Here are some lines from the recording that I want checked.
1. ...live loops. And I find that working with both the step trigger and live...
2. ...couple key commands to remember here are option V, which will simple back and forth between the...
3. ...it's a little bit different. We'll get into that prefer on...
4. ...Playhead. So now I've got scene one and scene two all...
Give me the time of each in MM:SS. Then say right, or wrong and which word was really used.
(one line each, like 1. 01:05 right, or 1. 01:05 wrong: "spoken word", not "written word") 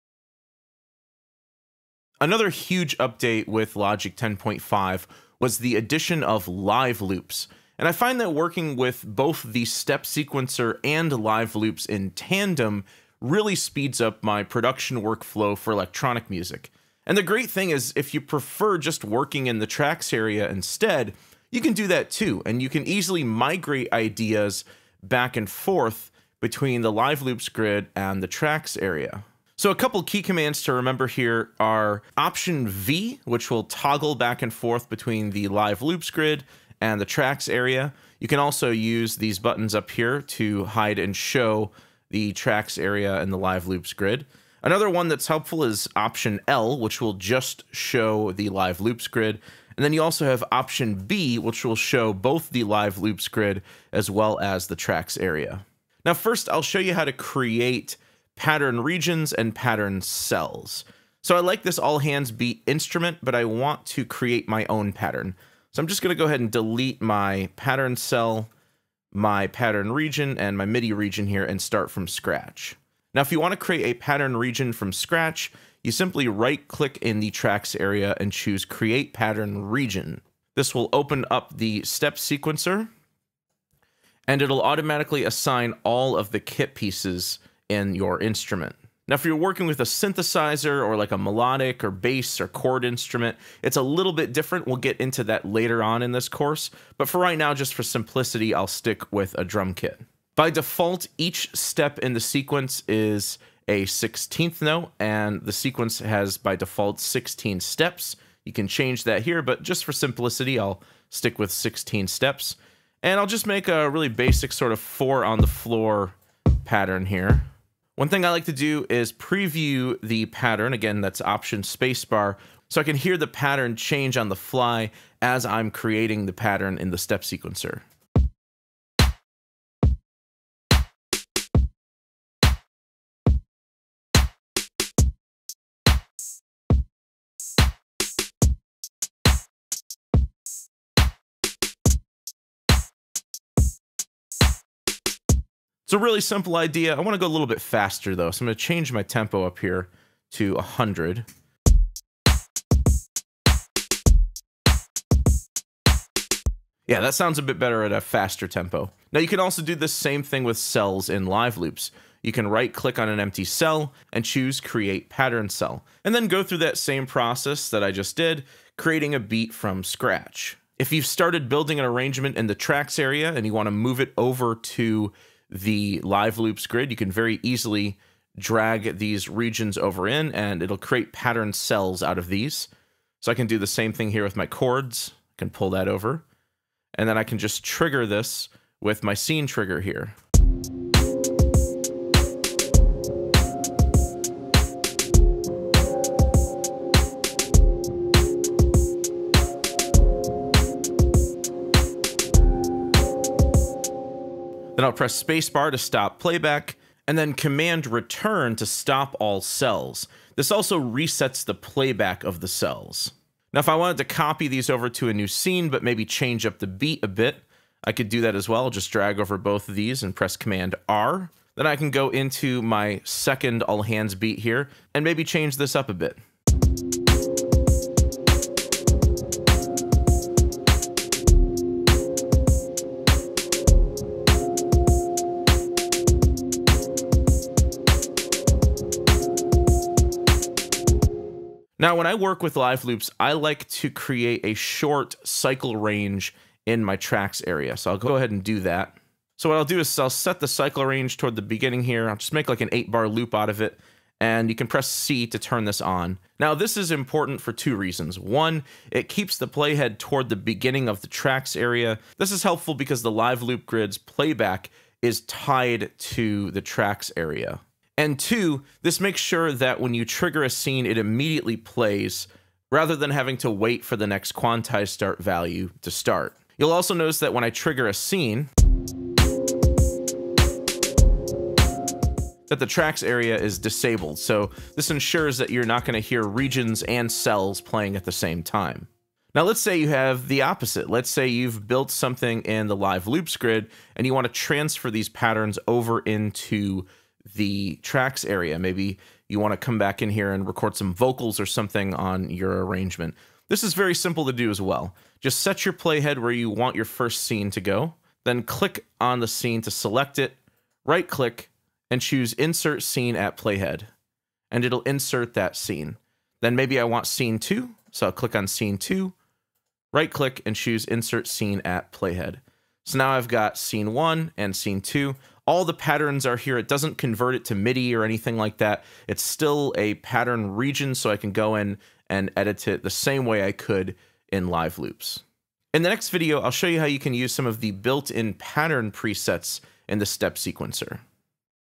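1. 00:06 wrong: "sequencer", not "trigger"
2. 00:29 wrong: "toggle", not "simple"
3. 01:33 wrong: "later", not "prefer"
4. 05:21 right.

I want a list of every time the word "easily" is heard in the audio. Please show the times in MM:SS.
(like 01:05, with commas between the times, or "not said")
00:22, 02:57.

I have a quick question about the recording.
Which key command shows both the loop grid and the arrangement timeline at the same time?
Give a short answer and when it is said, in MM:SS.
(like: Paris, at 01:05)
Option B, at 00:50.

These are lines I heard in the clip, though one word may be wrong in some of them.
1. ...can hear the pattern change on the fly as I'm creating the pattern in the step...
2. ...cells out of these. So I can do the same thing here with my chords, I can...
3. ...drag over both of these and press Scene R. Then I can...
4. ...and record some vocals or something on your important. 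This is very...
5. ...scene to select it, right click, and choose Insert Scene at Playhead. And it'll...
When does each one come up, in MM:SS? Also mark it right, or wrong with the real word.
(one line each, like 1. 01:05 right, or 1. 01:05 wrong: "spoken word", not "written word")
1. 02:02 right
2. 03:01 right
3. 03:38 wrong: "Command", not "Scene"
4. 05:00 wrong: "arrangement", not "important"
5. 05:09 right.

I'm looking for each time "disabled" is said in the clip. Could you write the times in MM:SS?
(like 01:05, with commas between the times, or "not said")
04:43.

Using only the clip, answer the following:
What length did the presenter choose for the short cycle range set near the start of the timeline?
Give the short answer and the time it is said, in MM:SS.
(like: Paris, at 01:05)
8 bars, at 04:12.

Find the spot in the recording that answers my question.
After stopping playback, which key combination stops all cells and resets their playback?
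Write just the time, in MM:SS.
03:27.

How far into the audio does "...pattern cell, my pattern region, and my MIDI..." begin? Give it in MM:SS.
01:07.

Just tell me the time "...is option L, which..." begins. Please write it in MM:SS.
00:45.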